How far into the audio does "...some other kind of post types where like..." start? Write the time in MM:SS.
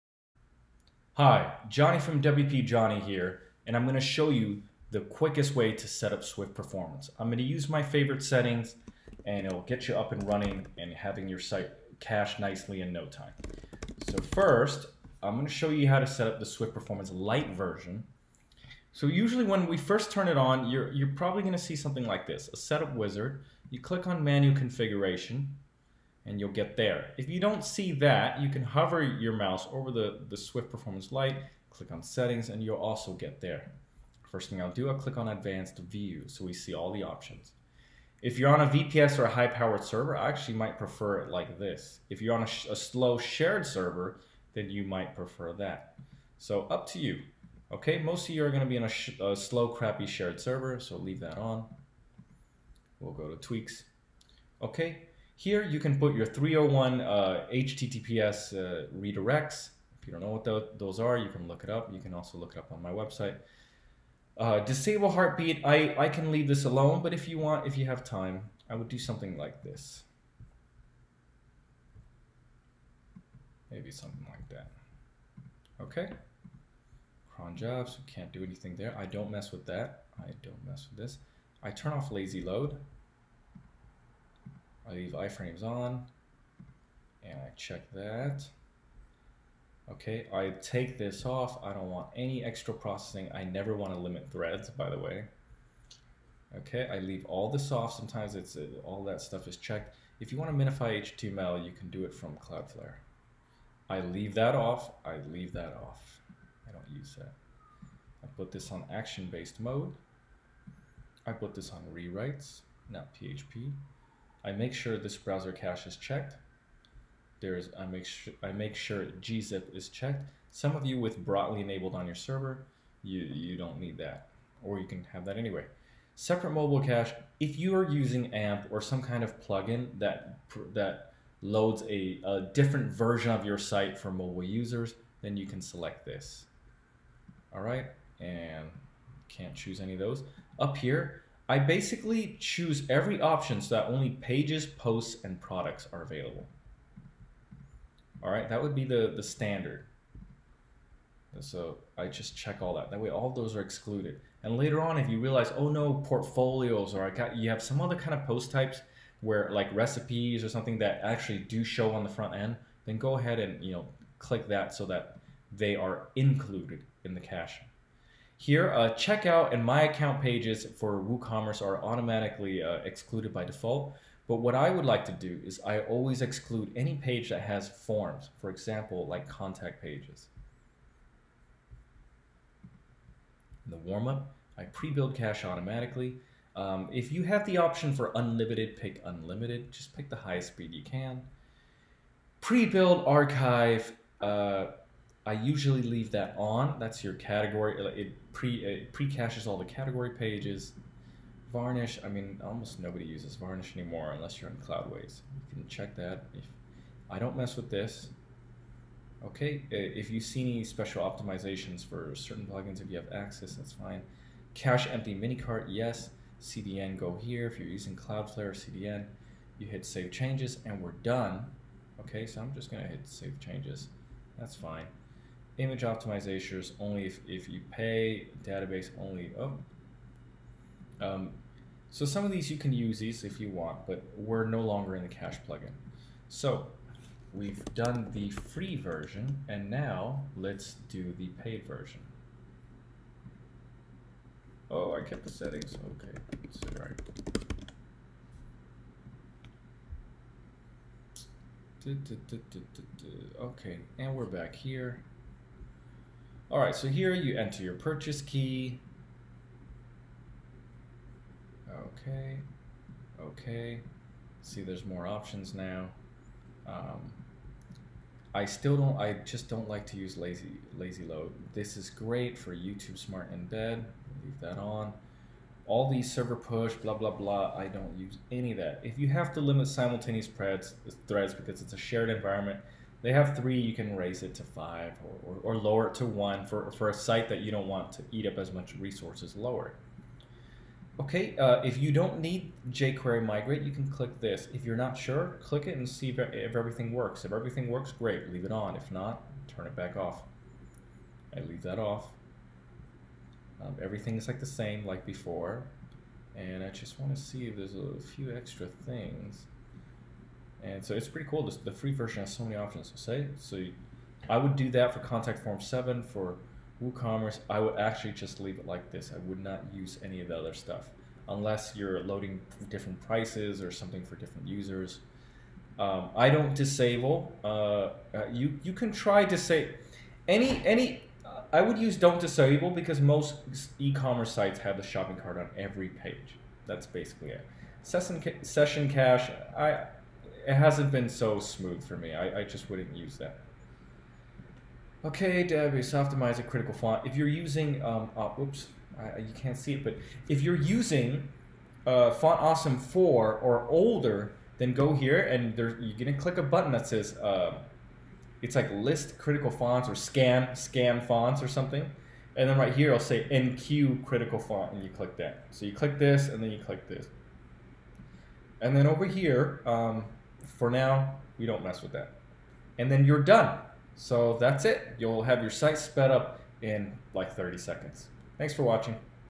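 02:37.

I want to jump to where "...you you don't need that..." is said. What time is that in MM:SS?
02:03.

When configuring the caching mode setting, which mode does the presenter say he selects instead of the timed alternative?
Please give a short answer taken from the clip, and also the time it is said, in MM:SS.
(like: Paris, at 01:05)
action-based mode, at 01:48.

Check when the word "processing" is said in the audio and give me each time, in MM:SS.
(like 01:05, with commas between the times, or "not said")
01:32.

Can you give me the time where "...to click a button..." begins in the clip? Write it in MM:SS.
05:56.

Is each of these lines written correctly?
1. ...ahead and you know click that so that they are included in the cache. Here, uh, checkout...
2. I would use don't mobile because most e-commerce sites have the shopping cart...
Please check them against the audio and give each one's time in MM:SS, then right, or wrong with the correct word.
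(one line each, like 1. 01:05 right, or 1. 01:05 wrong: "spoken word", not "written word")
1. 02:43 right
2. 05:31 wrong: "disable", not "mobile".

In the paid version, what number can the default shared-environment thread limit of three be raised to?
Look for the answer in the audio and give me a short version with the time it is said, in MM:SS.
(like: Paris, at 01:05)
5, at 04:44.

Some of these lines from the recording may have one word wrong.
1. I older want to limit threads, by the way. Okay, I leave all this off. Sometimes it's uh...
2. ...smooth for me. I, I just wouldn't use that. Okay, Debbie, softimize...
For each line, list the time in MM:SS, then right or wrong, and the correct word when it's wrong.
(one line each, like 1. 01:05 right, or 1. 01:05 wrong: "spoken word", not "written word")
1. 01:33 wrong: "never", not "older"
2. 05:41 right.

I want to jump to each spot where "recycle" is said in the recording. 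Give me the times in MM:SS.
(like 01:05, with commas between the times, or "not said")
not said.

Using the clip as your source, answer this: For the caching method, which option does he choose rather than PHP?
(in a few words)
rewrites.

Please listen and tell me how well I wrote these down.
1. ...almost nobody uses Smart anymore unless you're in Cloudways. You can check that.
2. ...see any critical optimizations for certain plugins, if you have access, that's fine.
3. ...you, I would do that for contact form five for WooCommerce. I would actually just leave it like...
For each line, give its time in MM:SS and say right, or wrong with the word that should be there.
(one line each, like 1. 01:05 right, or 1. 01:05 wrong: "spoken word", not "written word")
1. 03:22 wrong: "Varnish", not "Smart"
2. 03:30 wrong: "special", not "critical"
3. 05:13 wrong: "seven", not "five".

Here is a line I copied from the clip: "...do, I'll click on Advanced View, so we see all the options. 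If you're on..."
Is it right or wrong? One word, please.
right.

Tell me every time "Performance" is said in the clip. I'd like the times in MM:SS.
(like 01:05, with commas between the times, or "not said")
00:06, 00:16, 00:30.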